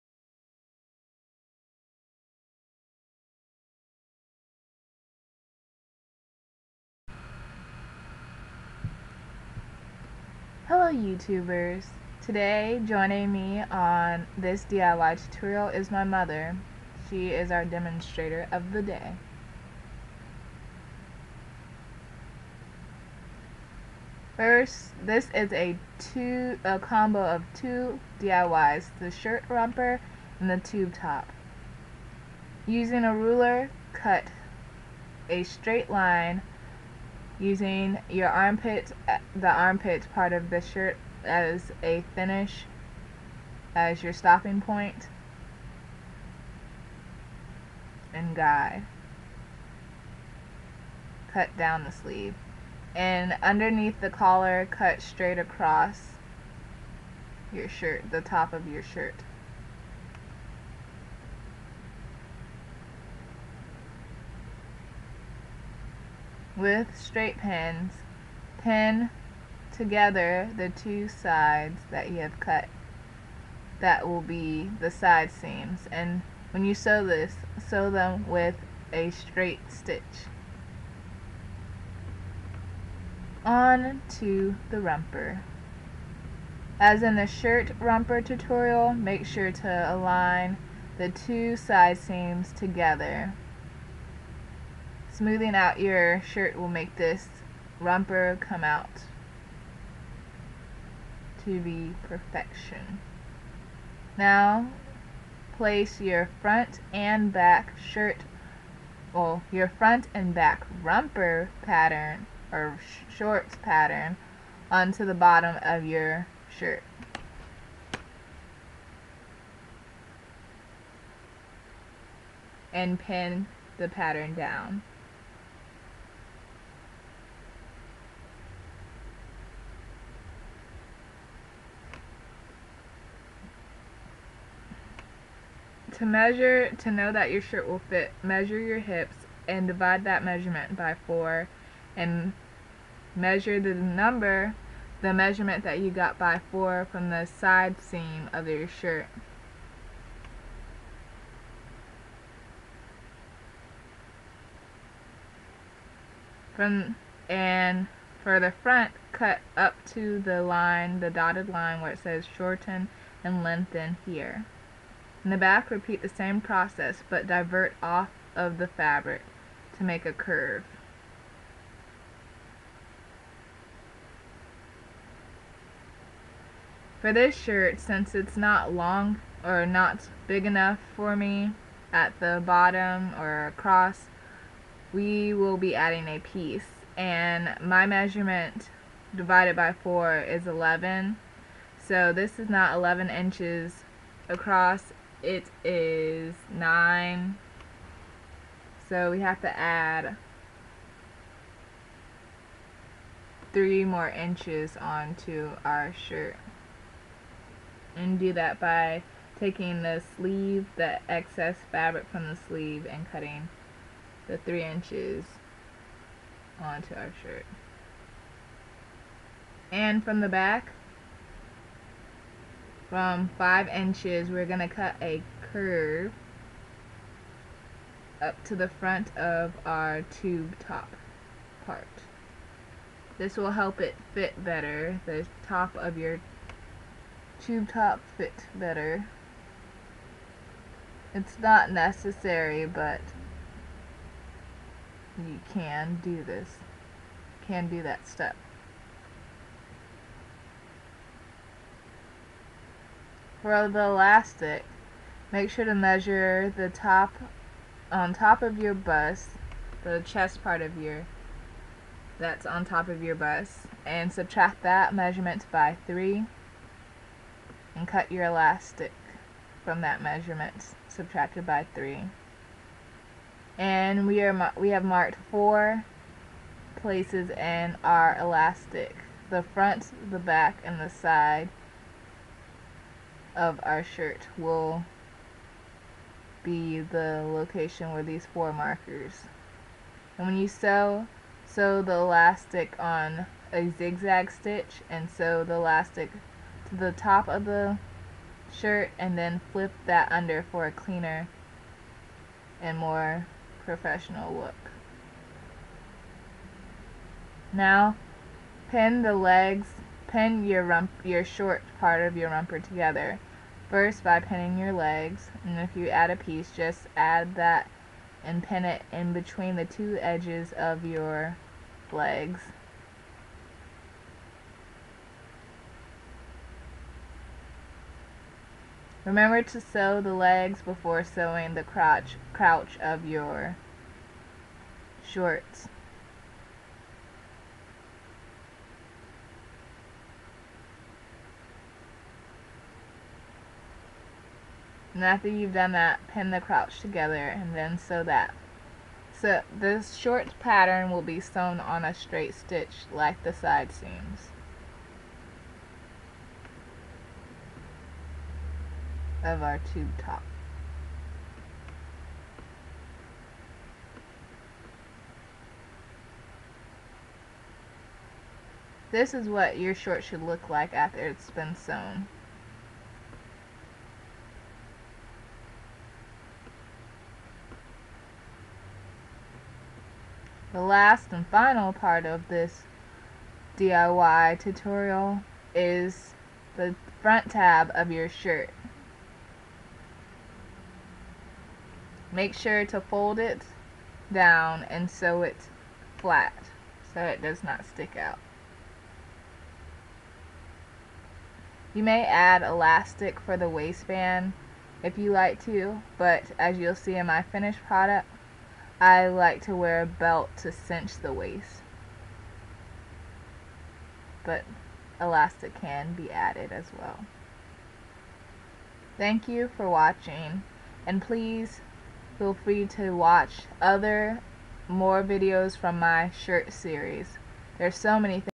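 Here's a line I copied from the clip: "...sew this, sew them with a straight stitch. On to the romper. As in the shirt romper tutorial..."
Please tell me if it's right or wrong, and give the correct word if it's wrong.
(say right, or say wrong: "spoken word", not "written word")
right.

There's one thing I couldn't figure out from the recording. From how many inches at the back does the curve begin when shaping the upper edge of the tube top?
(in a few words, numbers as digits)
5.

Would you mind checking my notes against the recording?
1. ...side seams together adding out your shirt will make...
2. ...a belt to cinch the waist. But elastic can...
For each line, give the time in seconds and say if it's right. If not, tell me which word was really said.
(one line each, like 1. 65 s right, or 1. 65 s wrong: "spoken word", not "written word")
1. 91 s wrong: "smoothing", not "adding"
2. 409 s right.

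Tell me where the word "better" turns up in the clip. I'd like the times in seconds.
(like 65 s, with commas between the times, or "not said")
234 s, 238 s.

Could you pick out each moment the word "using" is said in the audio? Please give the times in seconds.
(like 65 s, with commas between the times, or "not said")
32 s, 37 s.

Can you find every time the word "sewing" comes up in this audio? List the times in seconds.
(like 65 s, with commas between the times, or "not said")
331 s.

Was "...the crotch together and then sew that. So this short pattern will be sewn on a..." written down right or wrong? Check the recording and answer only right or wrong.
right.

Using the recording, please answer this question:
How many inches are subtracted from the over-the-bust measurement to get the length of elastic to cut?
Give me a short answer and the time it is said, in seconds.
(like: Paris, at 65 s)
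3, at 264 s.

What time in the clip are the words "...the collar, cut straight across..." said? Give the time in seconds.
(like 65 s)
54 s.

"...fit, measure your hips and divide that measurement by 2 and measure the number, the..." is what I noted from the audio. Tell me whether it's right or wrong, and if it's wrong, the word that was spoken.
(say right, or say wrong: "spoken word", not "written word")
wrong: "4", not "2".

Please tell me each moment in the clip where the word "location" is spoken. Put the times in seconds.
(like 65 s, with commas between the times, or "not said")
287 s.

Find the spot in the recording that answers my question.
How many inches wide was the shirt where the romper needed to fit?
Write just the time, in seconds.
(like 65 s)
196 s.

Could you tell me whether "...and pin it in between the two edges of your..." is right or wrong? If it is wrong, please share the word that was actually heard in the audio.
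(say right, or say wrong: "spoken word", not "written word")
right.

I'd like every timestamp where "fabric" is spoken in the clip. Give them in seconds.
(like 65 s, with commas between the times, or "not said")
168 s, 211 s.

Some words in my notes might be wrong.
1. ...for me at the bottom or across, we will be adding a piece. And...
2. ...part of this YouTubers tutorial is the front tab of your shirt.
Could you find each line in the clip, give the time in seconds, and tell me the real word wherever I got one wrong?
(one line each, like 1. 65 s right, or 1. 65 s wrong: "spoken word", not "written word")
1. 180 s right
2. 381 s wrong: "DIY", not "YouTubers".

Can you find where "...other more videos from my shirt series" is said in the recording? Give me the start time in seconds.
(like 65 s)
423 s.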